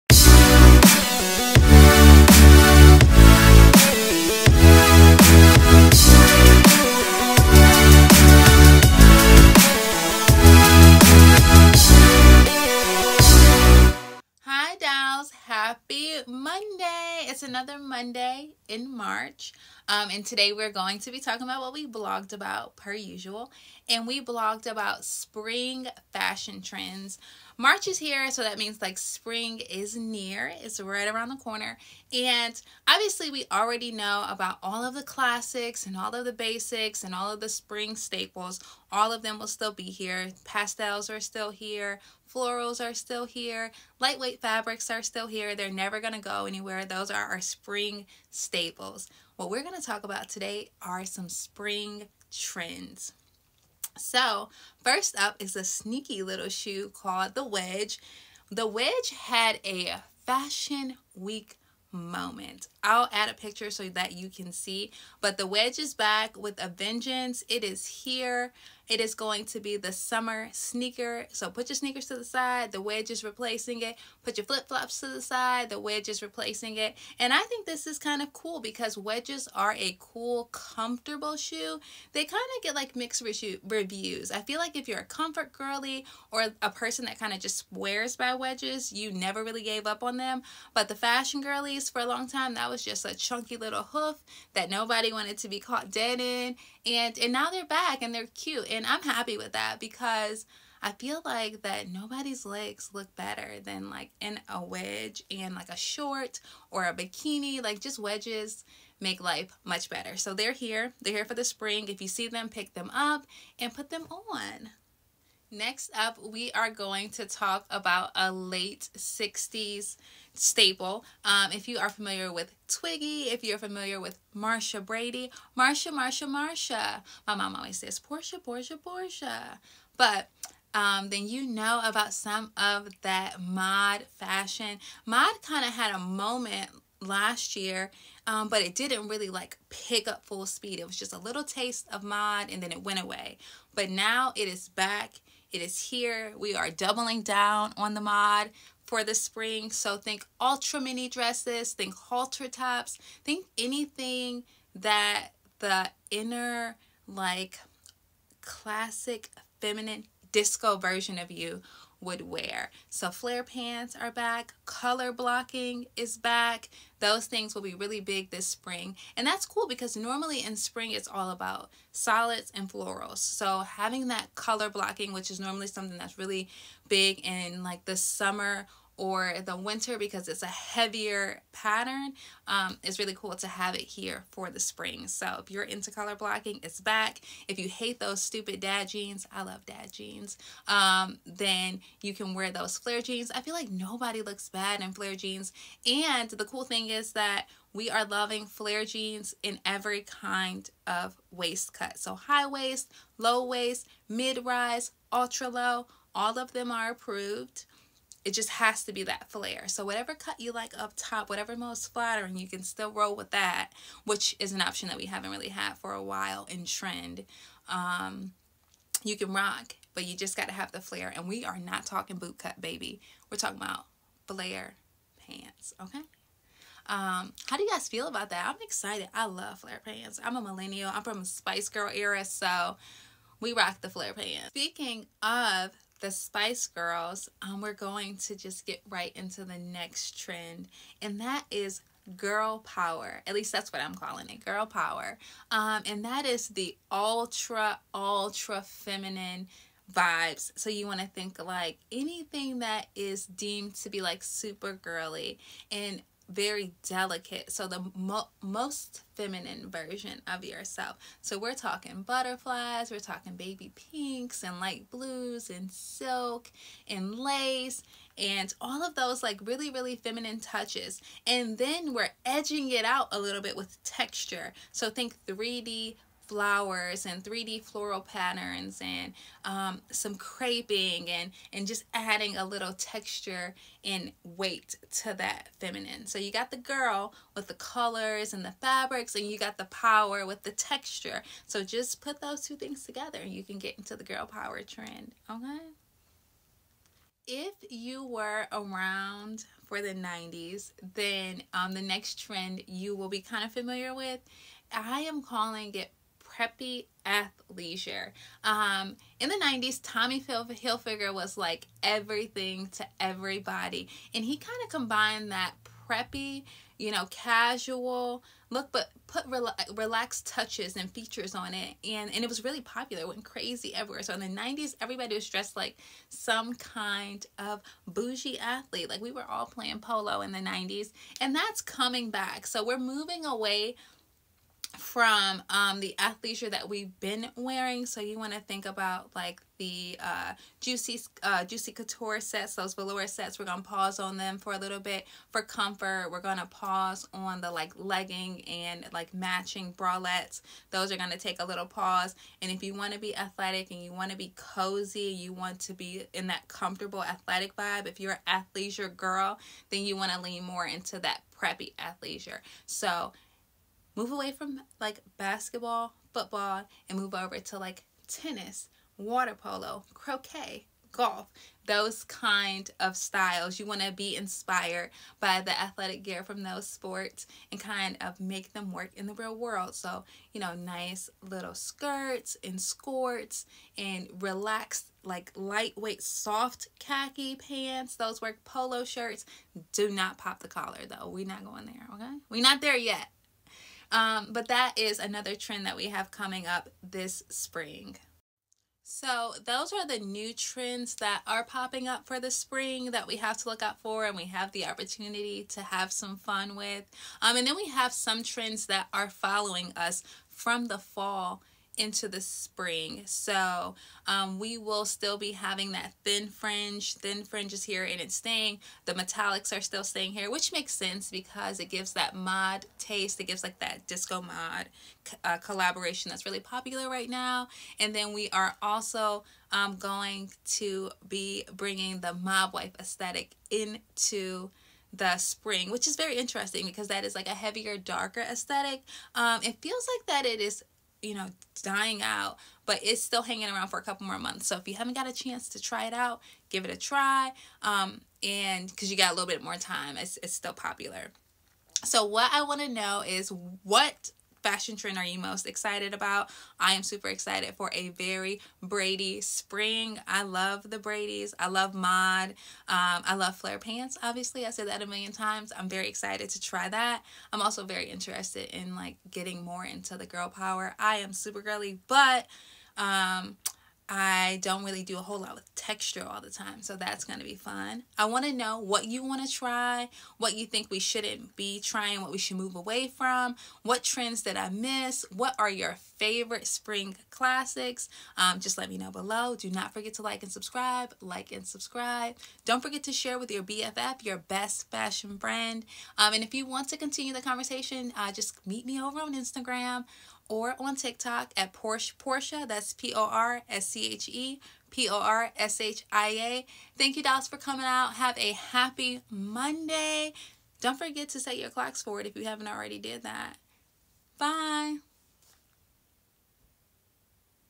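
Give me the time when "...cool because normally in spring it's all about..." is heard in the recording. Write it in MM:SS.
02:49.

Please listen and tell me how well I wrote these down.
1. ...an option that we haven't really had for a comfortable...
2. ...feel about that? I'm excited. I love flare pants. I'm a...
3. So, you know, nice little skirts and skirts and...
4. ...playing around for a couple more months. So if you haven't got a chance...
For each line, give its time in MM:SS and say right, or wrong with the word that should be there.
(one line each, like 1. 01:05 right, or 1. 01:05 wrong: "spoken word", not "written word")
1. 03:34 wrong: "while", not "comfortable"
2. 03:47 right
3. 06:19 right
4. 07:23 wrong: "hanging", not "playing".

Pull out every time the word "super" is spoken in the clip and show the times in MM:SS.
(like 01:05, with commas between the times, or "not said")
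04:14, 07:36, 07:51.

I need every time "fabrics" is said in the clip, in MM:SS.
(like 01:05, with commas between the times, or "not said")
00:44, 04:48.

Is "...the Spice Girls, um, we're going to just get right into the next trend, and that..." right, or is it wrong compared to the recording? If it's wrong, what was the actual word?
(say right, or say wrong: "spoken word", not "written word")
right.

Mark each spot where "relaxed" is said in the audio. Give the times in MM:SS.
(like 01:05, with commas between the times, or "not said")
05:19, 06:24.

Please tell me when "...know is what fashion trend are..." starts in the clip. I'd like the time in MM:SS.
07:32.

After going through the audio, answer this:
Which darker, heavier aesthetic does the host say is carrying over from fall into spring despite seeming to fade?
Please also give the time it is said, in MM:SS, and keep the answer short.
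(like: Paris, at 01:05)
Mob wife aesthetic, at 07:12.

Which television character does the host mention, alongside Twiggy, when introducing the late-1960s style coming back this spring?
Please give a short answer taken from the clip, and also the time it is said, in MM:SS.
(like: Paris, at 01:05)
Marsha Brady, at 02:04.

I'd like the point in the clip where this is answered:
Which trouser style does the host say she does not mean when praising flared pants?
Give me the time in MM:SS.
03:42.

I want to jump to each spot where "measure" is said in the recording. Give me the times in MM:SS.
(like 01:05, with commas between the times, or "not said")
not said.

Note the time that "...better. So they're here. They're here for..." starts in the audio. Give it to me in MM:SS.
01:49.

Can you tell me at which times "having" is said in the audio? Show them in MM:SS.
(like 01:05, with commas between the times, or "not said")
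02:53, 06:55.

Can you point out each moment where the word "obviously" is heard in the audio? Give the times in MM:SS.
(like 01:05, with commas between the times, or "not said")
00:32, 07:44.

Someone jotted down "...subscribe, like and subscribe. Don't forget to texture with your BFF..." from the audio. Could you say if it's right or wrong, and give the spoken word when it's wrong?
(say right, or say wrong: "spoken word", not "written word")
wrong: "share", not "texture".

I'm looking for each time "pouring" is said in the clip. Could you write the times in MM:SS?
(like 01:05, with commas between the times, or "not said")
not said.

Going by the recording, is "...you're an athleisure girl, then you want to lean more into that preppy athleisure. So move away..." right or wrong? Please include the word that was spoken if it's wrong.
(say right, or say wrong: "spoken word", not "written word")
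right.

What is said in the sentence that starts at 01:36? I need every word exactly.
And, and now they're back and they're cute.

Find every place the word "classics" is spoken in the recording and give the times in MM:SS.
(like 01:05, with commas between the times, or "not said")
00:35, 02:38, 08:07.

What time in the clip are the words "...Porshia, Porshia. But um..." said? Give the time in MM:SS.
02:08.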